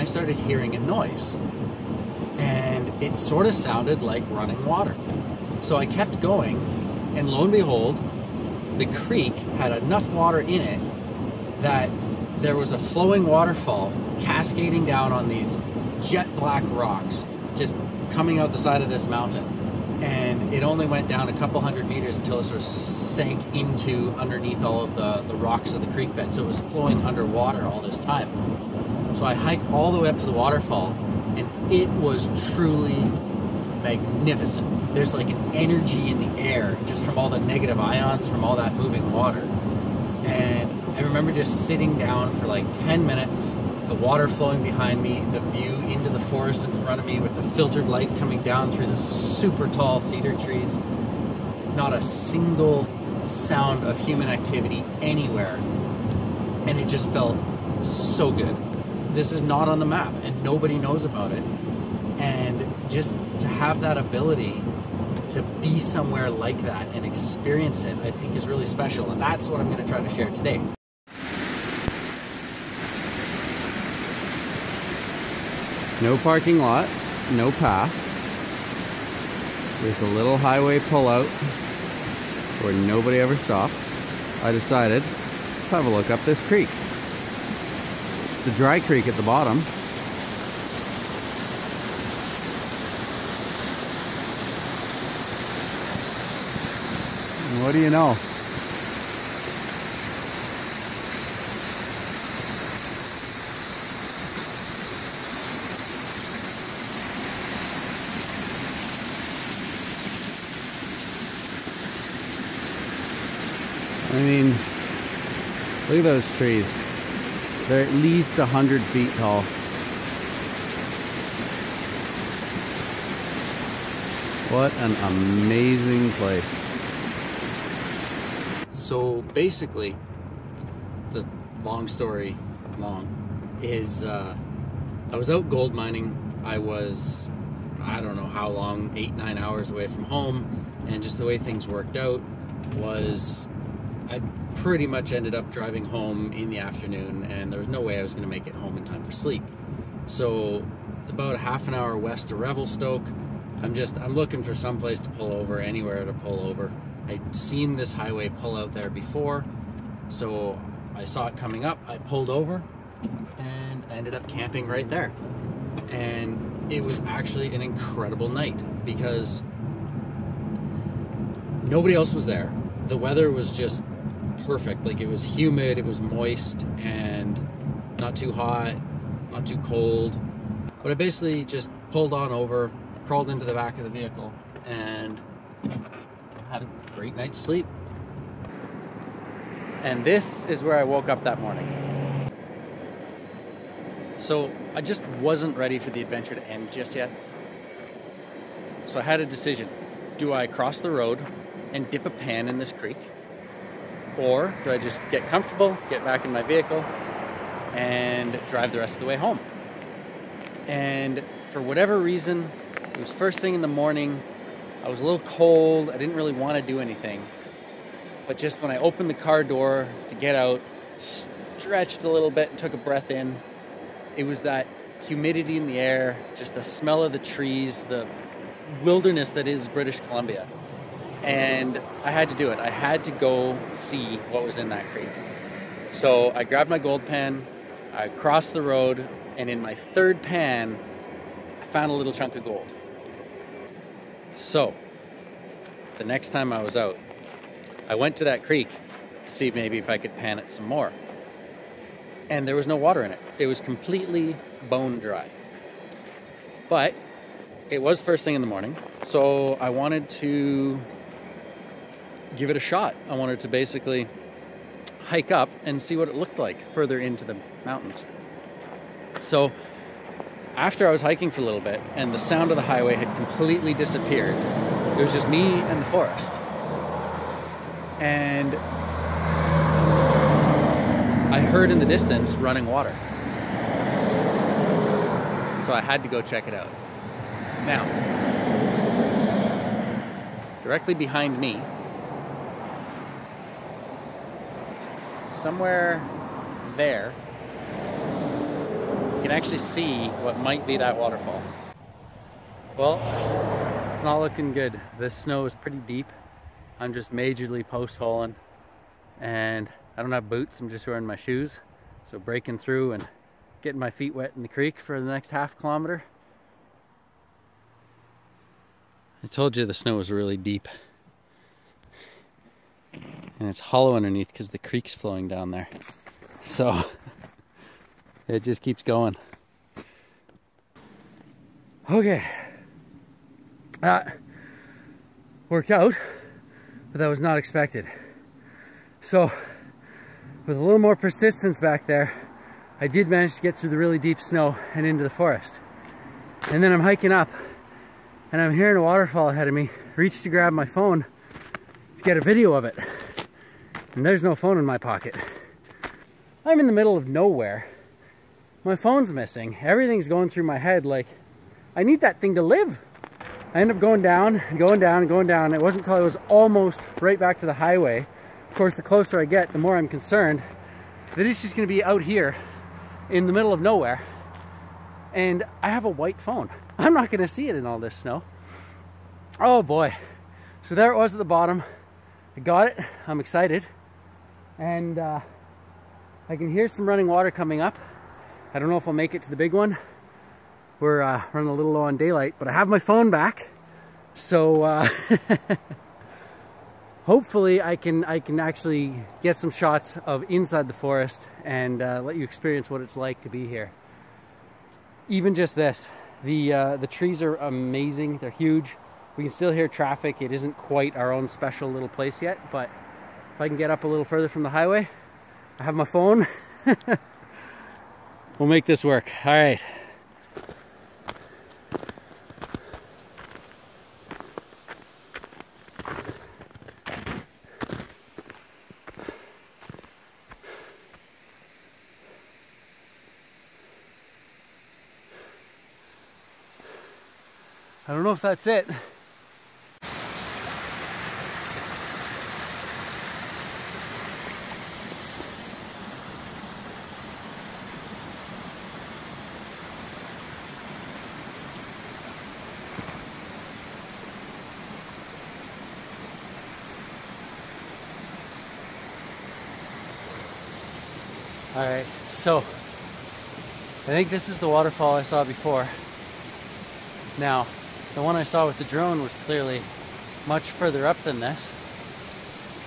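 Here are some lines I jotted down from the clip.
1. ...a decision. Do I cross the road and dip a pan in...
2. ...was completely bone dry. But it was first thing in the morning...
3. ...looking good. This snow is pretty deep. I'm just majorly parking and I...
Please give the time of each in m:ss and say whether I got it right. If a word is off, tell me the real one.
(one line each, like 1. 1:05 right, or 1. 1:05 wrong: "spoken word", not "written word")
1. 3:19 right
2. 4:13 right
3. 5:04 wrong: "postholing", not "parking".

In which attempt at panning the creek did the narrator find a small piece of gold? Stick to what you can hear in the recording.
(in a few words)
Third pan.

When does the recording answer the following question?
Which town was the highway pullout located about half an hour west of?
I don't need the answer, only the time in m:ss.
2:32.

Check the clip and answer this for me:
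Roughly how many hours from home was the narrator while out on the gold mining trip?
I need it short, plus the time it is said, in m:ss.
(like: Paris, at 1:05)
8 or 9 hours, at 2:18.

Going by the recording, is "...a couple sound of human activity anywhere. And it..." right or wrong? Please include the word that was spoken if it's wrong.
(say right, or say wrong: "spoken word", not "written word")
wrong: "single", not "couple".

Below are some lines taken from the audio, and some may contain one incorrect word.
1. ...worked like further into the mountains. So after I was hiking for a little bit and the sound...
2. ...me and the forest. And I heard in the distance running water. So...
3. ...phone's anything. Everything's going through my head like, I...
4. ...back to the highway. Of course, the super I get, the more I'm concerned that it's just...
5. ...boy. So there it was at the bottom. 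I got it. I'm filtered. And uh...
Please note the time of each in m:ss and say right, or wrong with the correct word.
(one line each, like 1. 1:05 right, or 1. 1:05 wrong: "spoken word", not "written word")
1. 4:26 wrong: "looked", not "worked"
2. 4:35 right
3. 5:58 wrong: "missing", not "anything"
4. 6:07 wrong: "closer", not "super"
5. 6:19 wrong: "excited", not "filtered".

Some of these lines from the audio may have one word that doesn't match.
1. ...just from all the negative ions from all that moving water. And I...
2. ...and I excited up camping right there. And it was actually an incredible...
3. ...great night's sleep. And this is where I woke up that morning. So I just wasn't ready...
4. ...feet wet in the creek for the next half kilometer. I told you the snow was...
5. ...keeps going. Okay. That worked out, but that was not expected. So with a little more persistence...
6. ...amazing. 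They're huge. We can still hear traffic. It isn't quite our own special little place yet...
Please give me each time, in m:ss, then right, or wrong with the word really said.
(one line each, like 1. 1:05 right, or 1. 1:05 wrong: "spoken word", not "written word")
1. 0:36 right
2. 2:43 wrong: "ended", not "excited"
3. 3:06 right
4. 5:13 right
5. 5:28 right
6. 6:47 right.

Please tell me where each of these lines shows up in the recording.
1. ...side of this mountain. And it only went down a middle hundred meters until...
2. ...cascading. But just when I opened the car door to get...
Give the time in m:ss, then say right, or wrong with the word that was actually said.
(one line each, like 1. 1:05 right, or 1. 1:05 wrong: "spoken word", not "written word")
1. 0:18 wrong: "couple", not "middle"
2. 3:36 wrong: "anything", not "cascading".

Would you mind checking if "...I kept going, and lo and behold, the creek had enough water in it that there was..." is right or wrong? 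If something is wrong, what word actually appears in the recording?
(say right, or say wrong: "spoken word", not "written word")
right.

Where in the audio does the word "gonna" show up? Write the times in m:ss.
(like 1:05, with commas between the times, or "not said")
6:11, 6:17.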